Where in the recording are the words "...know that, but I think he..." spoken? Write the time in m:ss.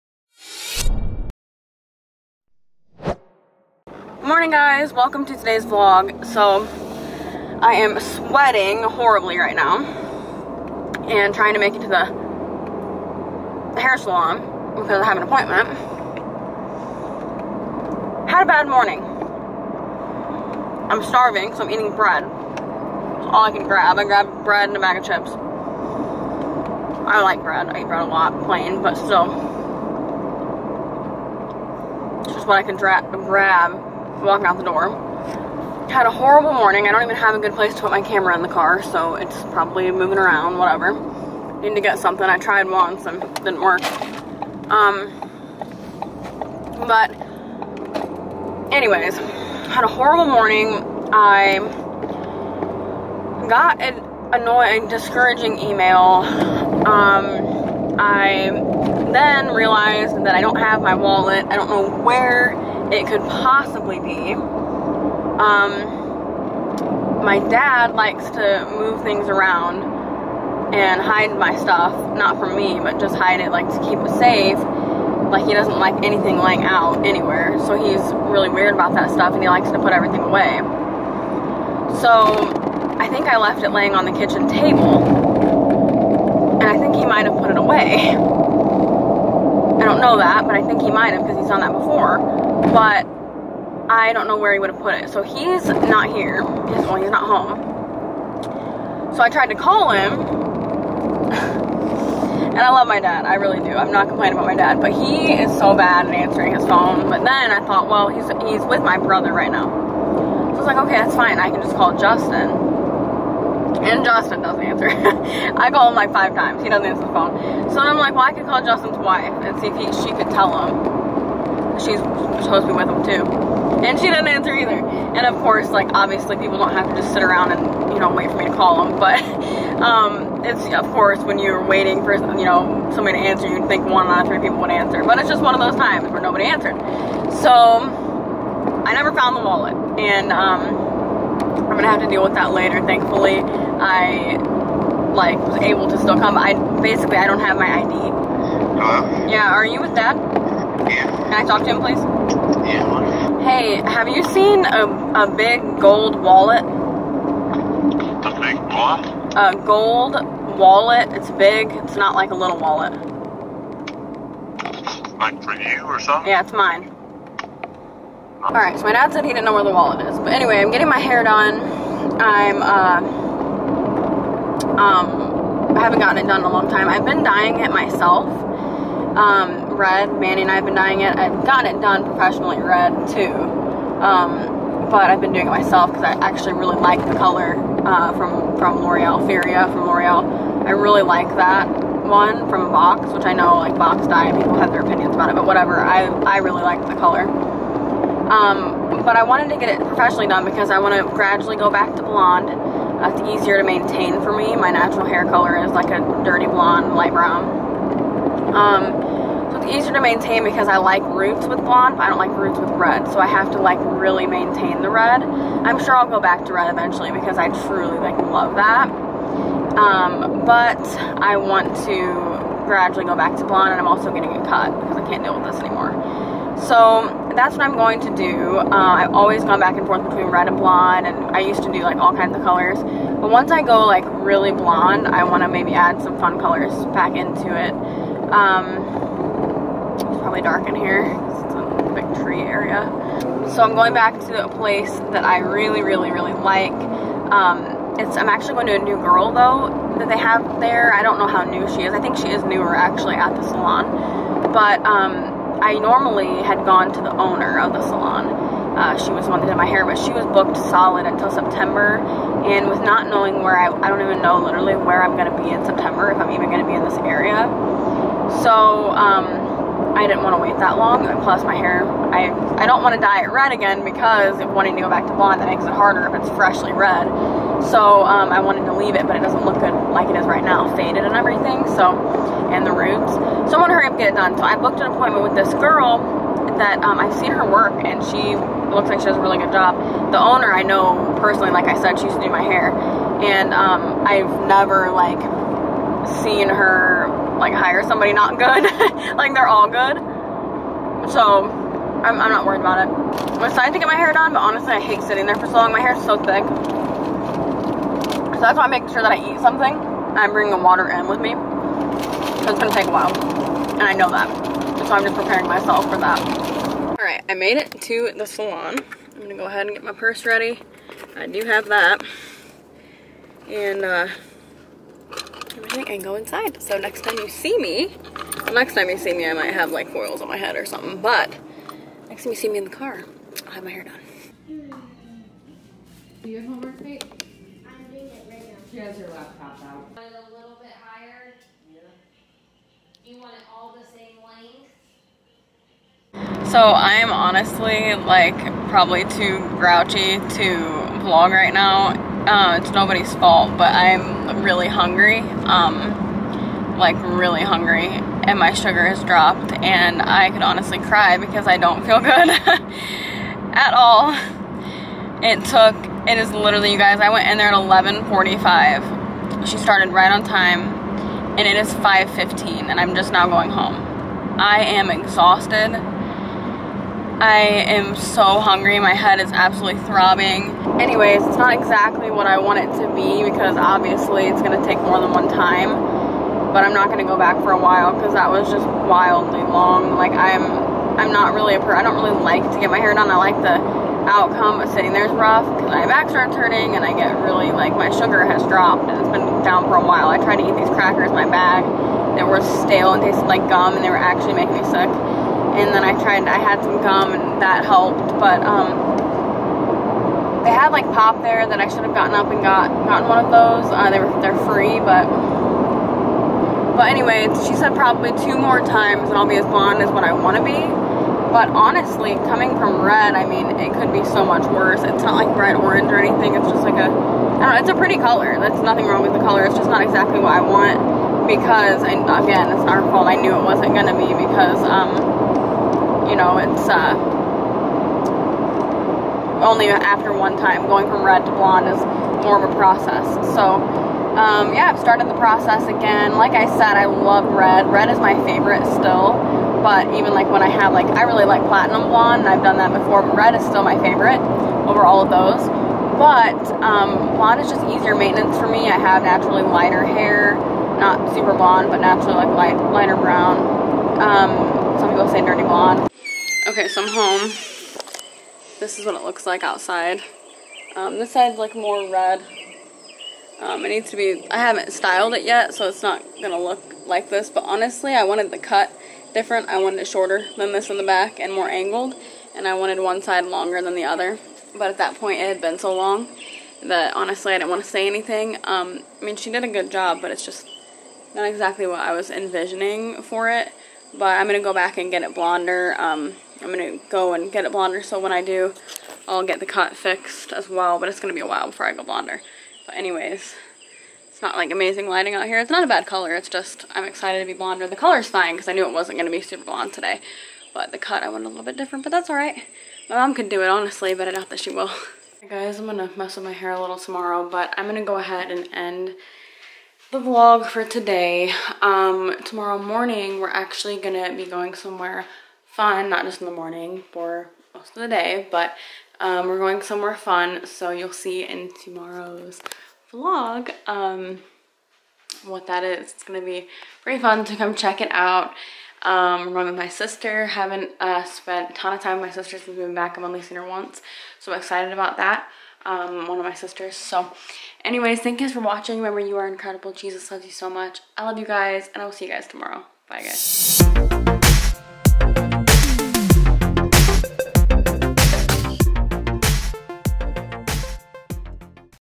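1:30.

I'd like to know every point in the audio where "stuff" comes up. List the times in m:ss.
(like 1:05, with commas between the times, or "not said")
1:11, 1:19.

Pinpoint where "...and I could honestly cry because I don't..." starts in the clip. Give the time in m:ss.
5:59.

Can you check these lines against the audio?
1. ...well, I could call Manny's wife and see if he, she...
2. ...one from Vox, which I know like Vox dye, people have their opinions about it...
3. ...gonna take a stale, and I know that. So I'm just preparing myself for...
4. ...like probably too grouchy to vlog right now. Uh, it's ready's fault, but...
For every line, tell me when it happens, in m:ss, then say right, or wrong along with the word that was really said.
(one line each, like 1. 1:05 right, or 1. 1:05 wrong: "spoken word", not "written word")
1. 1:58 wrong: "Justin", not "Manny"
2. 3:11 right
3. 5:12 wrong: "while", not "stale"
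4. 5:47 wrong: "nobody", not "ready".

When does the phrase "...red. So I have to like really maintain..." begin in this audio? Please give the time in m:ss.
3:32.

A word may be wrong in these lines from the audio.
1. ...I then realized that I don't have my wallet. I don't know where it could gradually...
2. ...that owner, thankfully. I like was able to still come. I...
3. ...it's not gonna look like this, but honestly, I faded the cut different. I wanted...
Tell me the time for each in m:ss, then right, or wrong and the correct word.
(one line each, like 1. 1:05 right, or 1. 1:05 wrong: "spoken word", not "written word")
1. 0:57 wrong: "possibly", not "gradually"
2. 2:22 wrong: "later", not "owner"
3. 7:55 wrong: "wanted", not "faded".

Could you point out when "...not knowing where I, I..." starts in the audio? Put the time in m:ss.
4:22.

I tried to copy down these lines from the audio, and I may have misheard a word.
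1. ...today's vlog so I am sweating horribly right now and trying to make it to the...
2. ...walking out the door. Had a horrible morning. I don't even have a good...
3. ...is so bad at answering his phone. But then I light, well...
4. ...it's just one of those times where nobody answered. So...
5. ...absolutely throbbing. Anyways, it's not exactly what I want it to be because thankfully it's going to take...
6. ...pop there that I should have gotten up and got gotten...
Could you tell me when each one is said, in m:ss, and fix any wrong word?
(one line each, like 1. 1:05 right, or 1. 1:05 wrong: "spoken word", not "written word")
1. 0:05 right
2. 0:34 right
3. 1:45 wrong: "thought", not "light"
4. 2:15 right
5. 6:19 wrong: "obviously", not "thankfully"
6. 6:50 right.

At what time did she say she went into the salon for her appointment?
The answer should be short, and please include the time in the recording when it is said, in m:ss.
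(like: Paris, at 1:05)
11:45, at 6:07.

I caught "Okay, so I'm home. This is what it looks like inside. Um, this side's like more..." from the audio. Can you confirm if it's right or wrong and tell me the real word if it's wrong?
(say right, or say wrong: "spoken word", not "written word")
wrong: "outside", not "inside".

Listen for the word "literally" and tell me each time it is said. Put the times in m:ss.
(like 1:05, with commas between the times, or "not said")
4:24, 6:06.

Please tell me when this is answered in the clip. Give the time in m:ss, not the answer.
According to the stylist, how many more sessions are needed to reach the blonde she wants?
6:58.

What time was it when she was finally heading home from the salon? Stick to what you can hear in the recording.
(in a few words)
5:15.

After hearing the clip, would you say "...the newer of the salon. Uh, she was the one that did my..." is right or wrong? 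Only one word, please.
wrong.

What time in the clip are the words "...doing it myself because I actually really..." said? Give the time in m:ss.
3:05.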